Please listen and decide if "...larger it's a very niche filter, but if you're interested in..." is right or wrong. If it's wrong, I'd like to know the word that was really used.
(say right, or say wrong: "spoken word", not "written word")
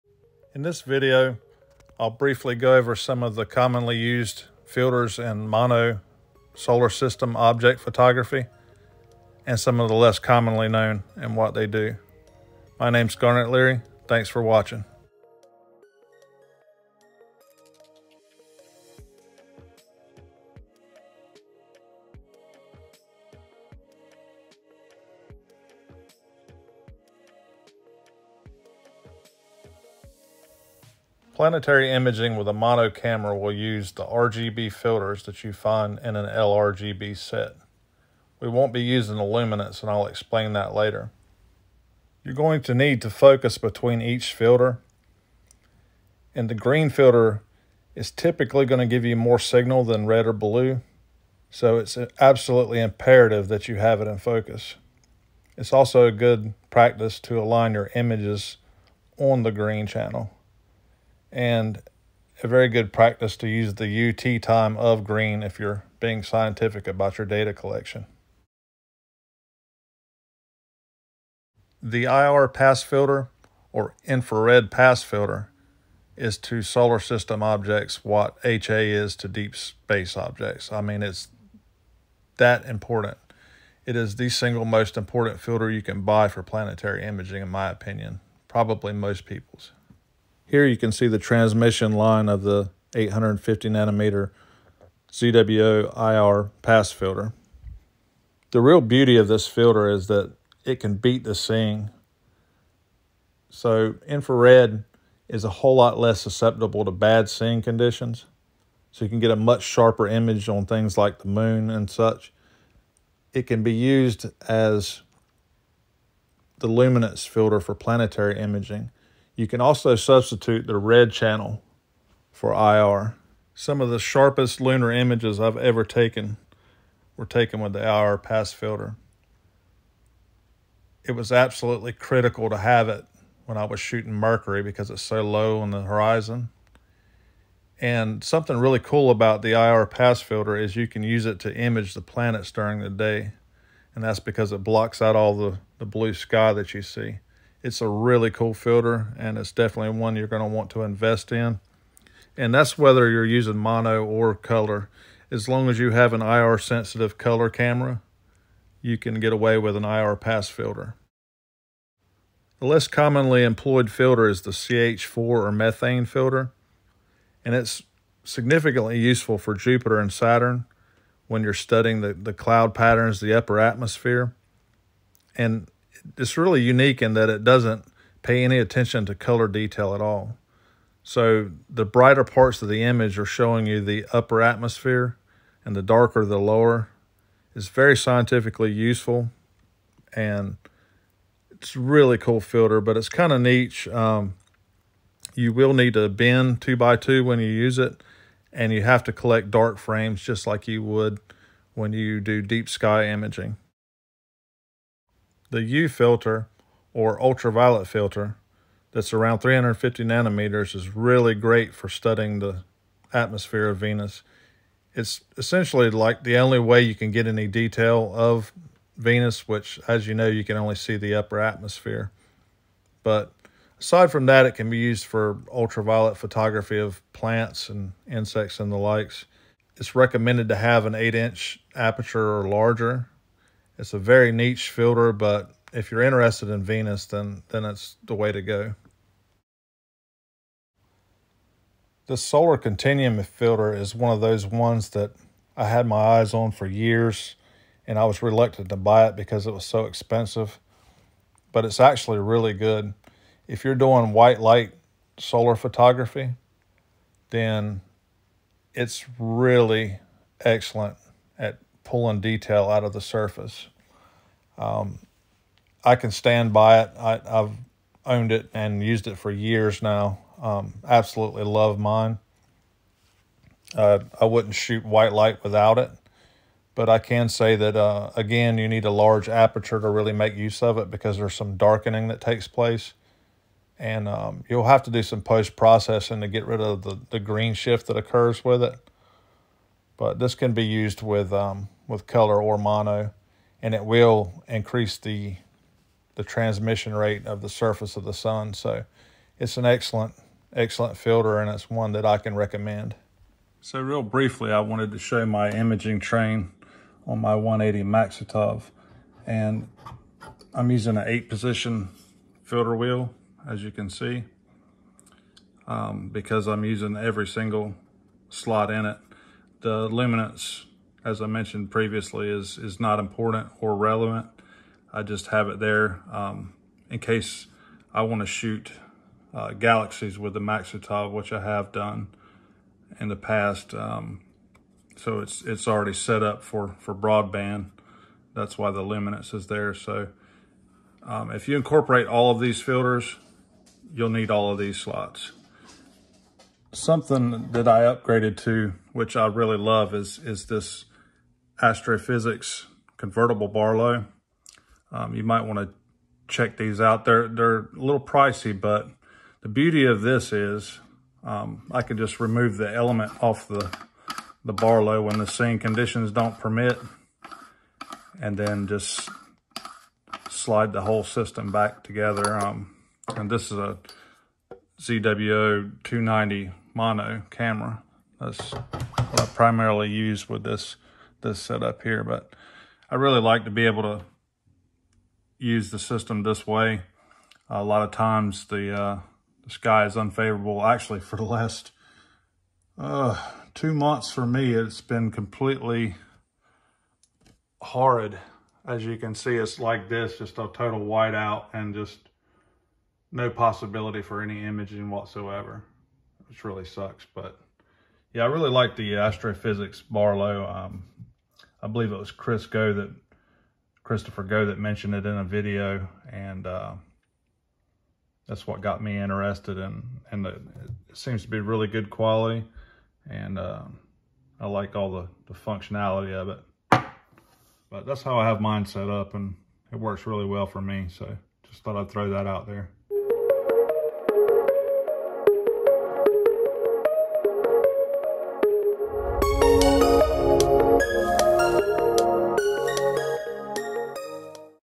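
right.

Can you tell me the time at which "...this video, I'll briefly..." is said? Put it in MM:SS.
00:00.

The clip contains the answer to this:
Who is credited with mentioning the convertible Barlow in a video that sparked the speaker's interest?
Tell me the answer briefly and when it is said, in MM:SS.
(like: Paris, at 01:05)
Christopher Go, at 06:53.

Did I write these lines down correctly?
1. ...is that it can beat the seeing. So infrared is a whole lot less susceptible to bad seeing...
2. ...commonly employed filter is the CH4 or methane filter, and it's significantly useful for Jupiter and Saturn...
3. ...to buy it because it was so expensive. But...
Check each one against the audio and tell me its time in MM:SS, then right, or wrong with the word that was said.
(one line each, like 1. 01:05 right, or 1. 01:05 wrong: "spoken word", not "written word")
1. 01:39 right
2. 02:42 right
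3. 04:08 right.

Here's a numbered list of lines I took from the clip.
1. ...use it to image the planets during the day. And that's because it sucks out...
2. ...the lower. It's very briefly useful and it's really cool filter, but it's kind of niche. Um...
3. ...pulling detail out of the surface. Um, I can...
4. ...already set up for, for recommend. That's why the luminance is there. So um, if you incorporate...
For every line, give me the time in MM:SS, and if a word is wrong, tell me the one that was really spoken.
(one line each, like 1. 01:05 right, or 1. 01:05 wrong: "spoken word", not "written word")
1. 02:21 wrong: "blocks", not "sucks"
2. 03:06 wrong: "scientifically", not "briefly"
3. 04:21 right
4. 05:35 wrong: "broadband", not "recommend".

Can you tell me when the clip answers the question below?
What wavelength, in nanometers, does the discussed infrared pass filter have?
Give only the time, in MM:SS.
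01:32.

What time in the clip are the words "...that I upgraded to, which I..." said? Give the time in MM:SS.
05:47.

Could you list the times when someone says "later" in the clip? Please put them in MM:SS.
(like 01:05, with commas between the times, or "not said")
00:40.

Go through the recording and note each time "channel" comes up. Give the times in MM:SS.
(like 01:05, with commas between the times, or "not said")
00:59, 02:01.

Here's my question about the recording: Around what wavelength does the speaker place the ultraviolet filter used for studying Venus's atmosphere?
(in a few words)
350 nanometers.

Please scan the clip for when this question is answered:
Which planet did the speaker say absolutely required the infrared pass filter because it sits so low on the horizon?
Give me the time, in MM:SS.
02:14.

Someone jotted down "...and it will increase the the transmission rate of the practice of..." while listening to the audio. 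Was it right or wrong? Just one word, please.
wrong.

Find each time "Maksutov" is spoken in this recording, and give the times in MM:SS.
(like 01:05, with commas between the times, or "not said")
05:07, 05:30.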